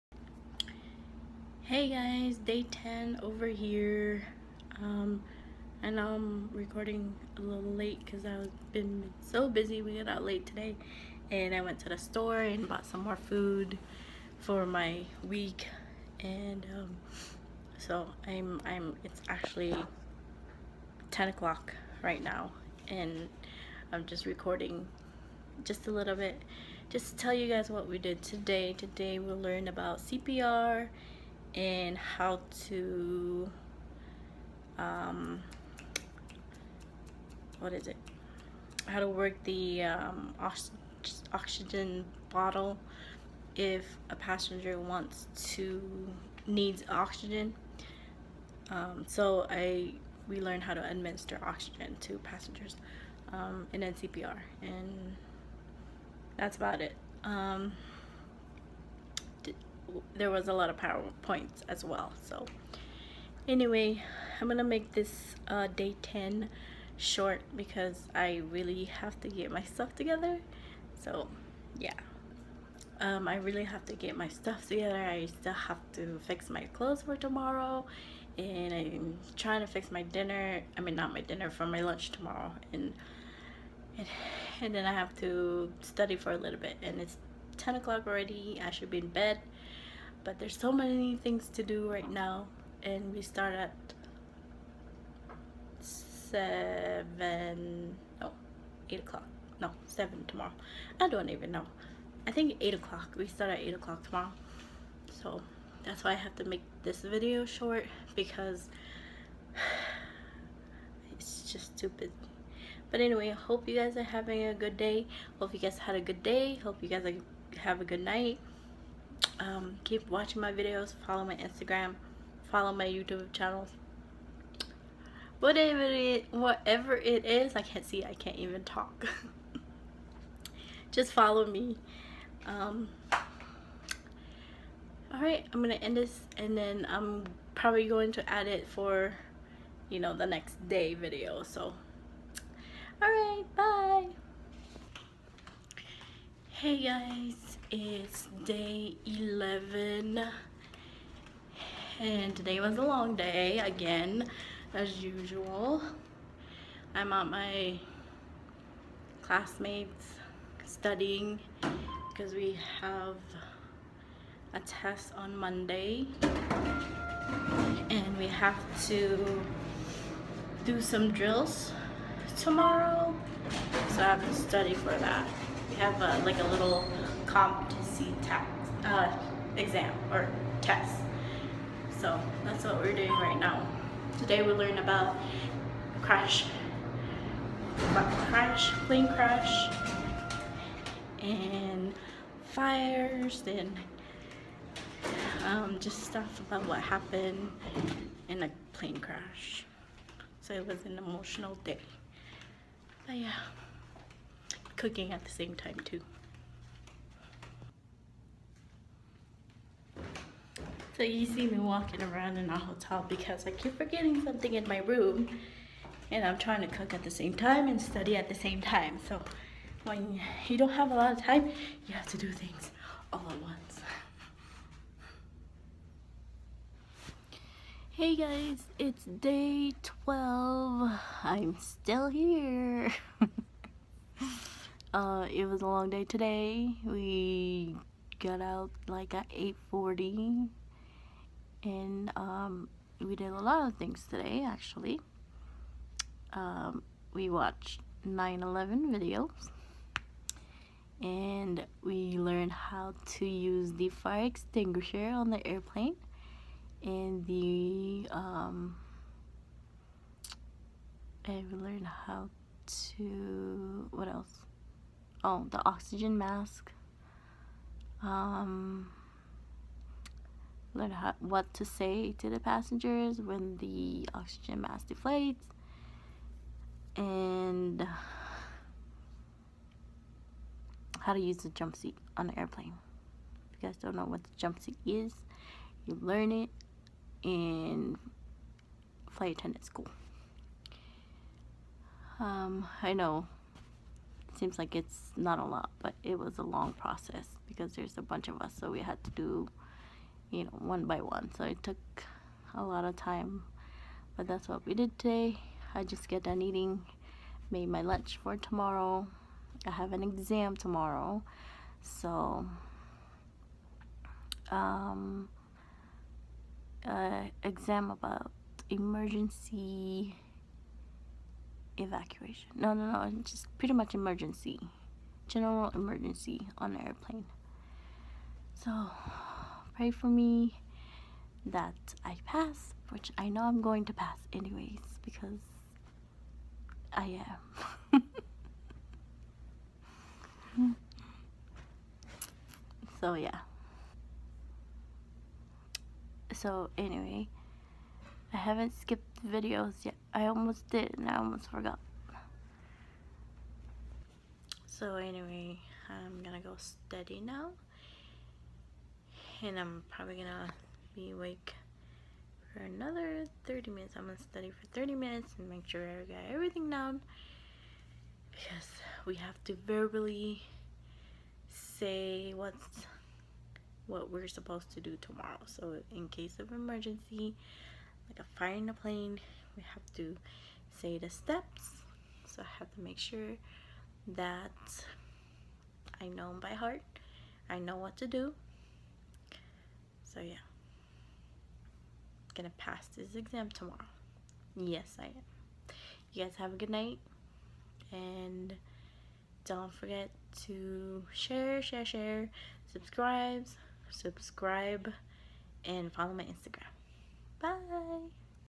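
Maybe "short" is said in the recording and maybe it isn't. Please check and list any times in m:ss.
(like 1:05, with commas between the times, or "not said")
1:06, 1:47.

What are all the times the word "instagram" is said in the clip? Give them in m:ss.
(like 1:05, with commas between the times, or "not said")
2:01, 6:46.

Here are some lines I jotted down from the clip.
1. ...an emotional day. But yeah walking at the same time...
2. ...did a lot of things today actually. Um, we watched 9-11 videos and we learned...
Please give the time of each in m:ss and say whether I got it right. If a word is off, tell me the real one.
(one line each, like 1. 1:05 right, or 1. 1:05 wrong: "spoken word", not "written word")
1. 3:20 wrong: "cooking", not "walking"
2. 4:03 right.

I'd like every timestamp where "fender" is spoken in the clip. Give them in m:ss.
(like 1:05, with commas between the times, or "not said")
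not said.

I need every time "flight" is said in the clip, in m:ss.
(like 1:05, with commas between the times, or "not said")
4:49.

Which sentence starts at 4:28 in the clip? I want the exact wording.
Um, learn how, what to say to the passengers when the oxygen mask deflates.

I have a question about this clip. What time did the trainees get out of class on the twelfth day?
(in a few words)
8:40.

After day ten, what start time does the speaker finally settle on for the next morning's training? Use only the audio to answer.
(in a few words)
8 o'clock.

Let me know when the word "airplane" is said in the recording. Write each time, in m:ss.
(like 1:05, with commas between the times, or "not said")
4:15, 4:42, 5:26.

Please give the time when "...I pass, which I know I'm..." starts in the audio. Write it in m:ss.
5:32.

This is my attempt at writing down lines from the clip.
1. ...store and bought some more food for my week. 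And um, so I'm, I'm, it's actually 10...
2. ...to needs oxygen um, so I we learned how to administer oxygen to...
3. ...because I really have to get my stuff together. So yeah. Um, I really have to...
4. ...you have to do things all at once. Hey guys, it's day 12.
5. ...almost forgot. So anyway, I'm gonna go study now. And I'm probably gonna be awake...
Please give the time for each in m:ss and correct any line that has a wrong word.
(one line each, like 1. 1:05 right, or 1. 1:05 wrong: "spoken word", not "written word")
1. 0:11 right
2. 0:45 right
3. 1:07 right
4. 3:41 right
5. 5:51 wrong: "steady", not "study".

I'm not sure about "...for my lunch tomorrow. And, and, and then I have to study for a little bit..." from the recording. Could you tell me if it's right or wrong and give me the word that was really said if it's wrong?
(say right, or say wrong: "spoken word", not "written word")
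right.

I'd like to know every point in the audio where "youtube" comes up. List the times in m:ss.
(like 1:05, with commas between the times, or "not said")
2:02.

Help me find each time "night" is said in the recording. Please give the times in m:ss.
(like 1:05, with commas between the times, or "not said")
1:58, 6:36.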